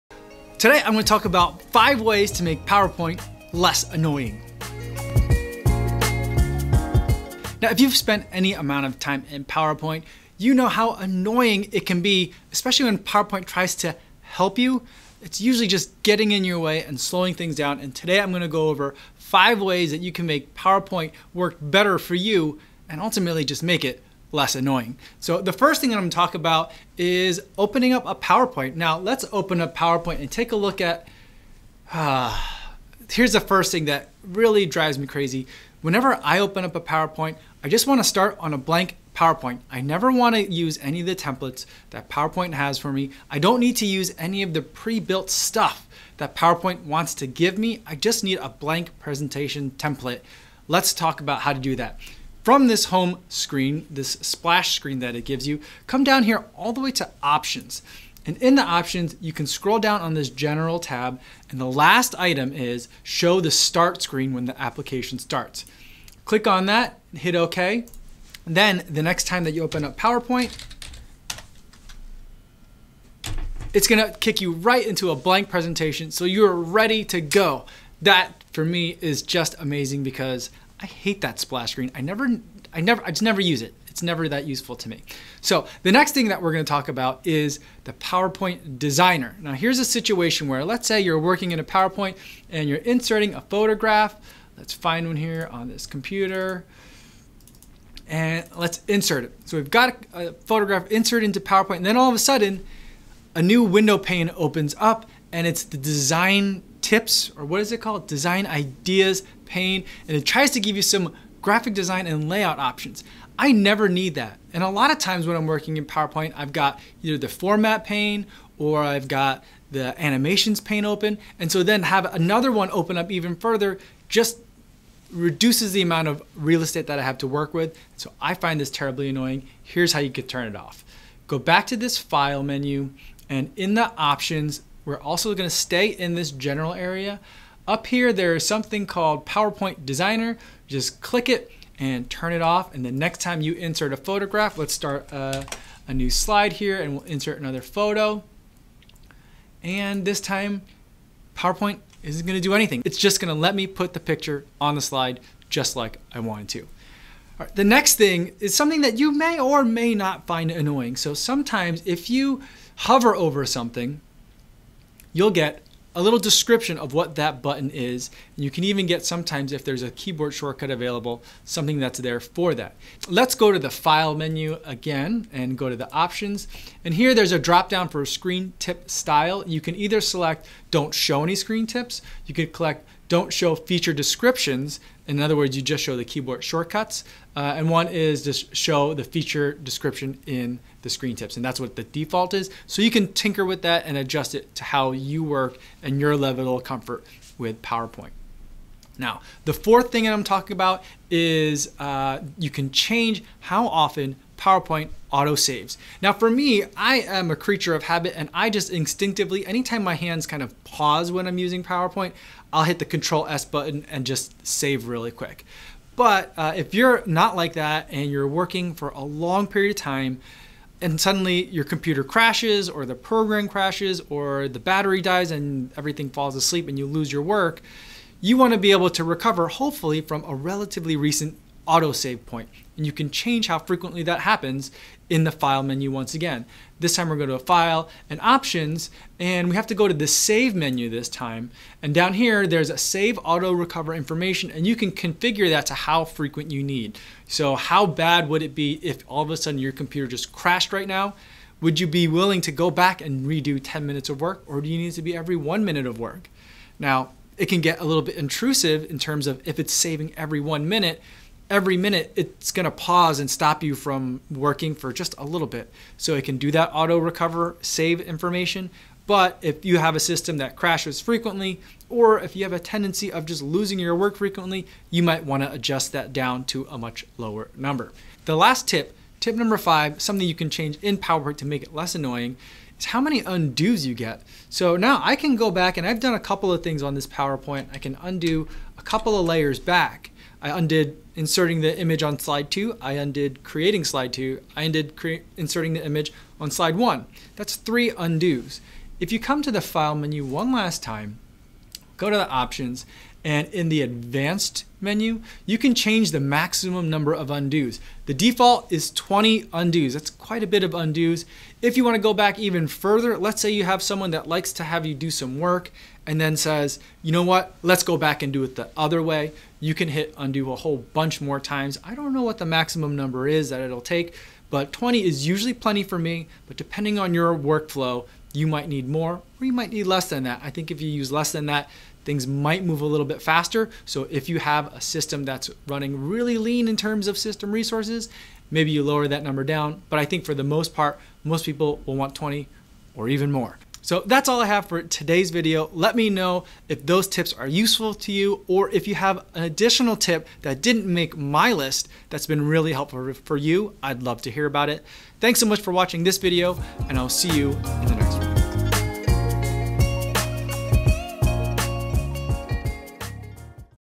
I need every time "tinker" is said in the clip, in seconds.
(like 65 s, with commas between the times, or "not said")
193 s.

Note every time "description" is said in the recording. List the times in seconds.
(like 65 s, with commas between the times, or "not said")
166 s, 183 s, 189 s.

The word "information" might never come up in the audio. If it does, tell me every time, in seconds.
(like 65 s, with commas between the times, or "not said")
243 s, 268 s.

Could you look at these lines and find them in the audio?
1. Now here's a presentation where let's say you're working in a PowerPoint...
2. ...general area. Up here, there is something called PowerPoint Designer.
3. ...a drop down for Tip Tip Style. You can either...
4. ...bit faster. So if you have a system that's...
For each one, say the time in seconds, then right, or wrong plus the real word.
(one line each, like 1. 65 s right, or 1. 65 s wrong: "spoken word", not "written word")
1. 89 s wrong: "situation", not "presentation"
2. 136 s right
3. 177 s wrong: "Screen", not "Tip"
4. 333 s right.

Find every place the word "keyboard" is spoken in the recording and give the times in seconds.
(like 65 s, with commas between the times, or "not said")
169 s, 186 s.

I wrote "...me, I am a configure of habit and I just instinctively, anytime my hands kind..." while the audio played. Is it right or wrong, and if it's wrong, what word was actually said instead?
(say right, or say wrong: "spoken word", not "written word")
wrong: "creature", not "configure".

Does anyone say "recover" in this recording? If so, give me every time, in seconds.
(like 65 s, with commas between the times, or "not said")
229 s, 243 s, 266 s.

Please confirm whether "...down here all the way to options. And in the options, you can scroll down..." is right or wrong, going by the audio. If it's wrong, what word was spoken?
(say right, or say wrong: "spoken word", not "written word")
right.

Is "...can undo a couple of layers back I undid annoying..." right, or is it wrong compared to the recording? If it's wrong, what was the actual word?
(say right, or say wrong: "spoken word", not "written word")
wrong: "inserting", not "annoying".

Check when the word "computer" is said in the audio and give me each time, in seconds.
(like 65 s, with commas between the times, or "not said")
95 s, 221 s, 249 s.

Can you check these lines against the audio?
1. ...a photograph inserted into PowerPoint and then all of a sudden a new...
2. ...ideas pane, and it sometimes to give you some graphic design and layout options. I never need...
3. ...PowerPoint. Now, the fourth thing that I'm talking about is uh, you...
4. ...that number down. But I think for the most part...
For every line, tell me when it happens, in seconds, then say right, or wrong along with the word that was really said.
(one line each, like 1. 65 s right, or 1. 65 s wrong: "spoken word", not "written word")
1. 100 s right
2. 108 s wrong: "tries", not "sometimes"
3. 197 s right
4. 339 s right.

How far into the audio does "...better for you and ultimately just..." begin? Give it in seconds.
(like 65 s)
21 s.